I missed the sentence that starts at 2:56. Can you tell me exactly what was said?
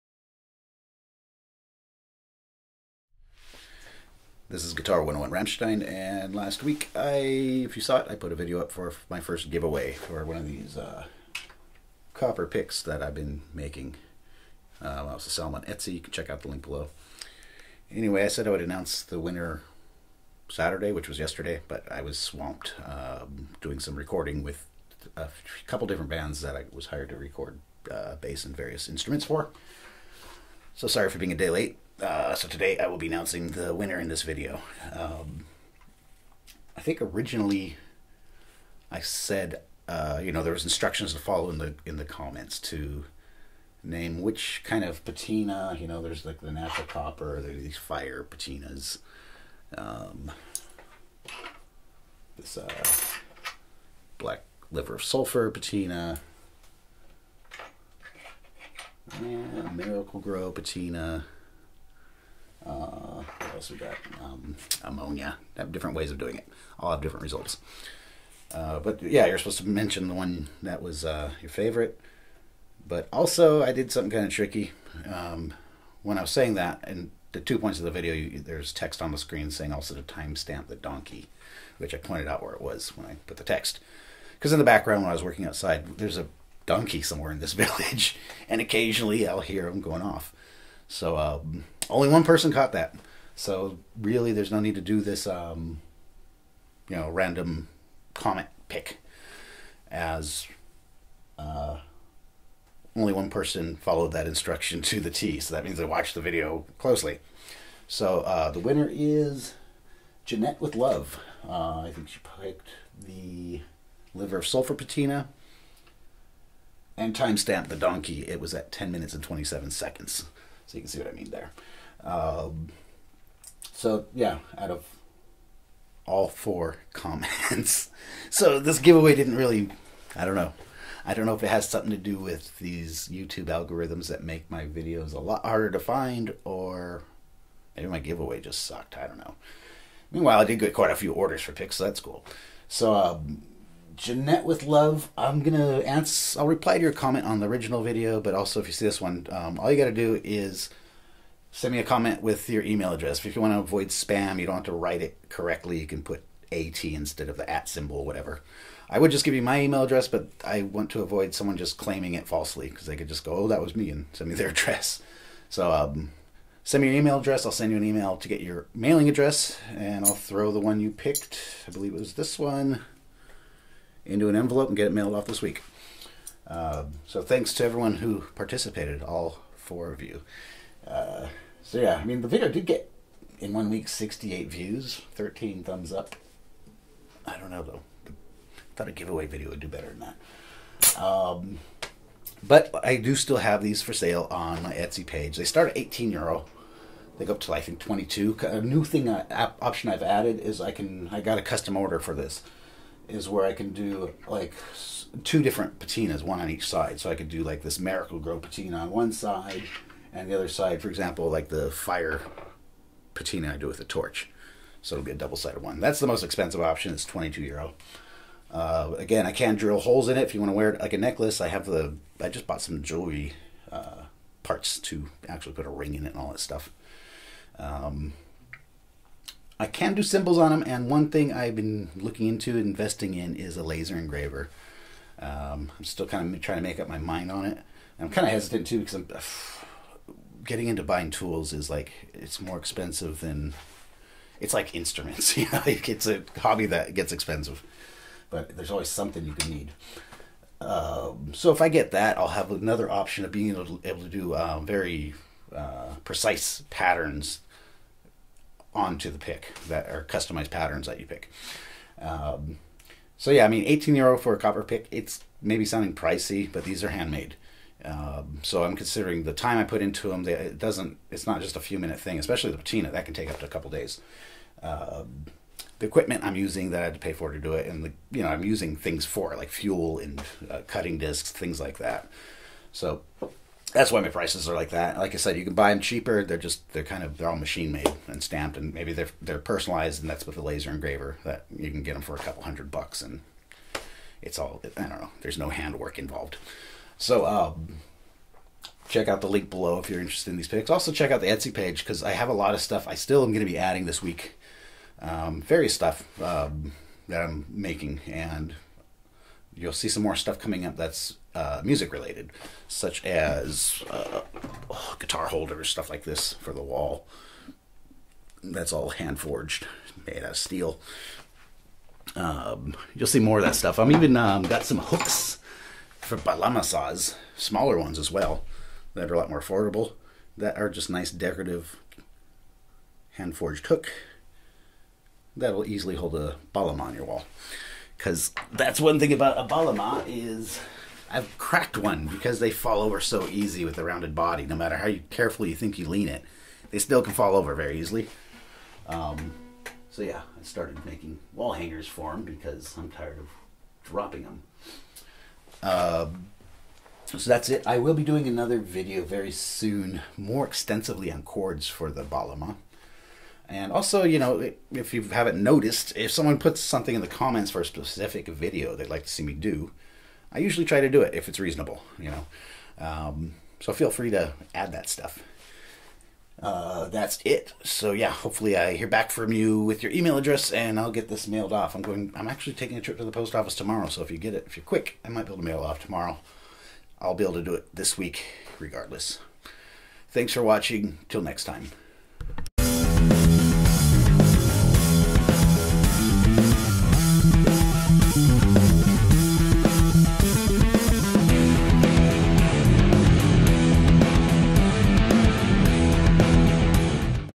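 Uh, so thanks to everyone who participated, all four of you.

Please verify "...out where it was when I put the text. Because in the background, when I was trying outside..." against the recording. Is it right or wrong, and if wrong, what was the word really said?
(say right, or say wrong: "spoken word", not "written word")
wrong: "working", not "trying".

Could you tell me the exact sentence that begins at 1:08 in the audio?
Uh, but yeah, you're supposed to mention the one that was uh, your favorite.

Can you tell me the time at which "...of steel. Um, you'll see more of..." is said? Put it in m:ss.
5:20.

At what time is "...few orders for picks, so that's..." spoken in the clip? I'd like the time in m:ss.
2:20.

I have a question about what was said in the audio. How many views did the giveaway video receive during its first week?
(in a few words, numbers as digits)
68.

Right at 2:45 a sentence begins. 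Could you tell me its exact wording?
So um, send me your email address.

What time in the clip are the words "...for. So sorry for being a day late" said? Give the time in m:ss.
0:29.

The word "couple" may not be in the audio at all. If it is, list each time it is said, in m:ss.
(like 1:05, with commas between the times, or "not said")
0:25, 4:33, 4:52.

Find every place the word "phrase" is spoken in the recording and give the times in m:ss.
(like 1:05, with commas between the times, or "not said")
not said.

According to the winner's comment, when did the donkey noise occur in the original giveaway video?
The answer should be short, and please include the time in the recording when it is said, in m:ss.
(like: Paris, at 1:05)
10 minutes 27 seconds, at 1:58.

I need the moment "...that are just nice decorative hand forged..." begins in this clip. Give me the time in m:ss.
5:30.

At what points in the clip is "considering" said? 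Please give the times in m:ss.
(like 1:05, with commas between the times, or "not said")
4:28.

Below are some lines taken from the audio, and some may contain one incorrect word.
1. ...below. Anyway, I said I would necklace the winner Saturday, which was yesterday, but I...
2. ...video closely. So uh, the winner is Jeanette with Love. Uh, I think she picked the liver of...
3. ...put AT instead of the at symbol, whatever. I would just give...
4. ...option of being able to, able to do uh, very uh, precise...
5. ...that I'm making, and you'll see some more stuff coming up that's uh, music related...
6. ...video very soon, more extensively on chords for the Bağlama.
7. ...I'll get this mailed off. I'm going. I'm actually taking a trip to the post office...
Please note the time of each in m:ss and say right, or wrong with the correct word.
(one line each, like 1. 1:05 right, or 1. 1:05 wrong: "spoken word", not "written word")
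1. 0:16 wrong: "announce", not "necklace"
2. 1:46 right
3. 2:36 right
4. 4:12 right
5. 5:07 right
6. 5:58 right
7. 6:20 right.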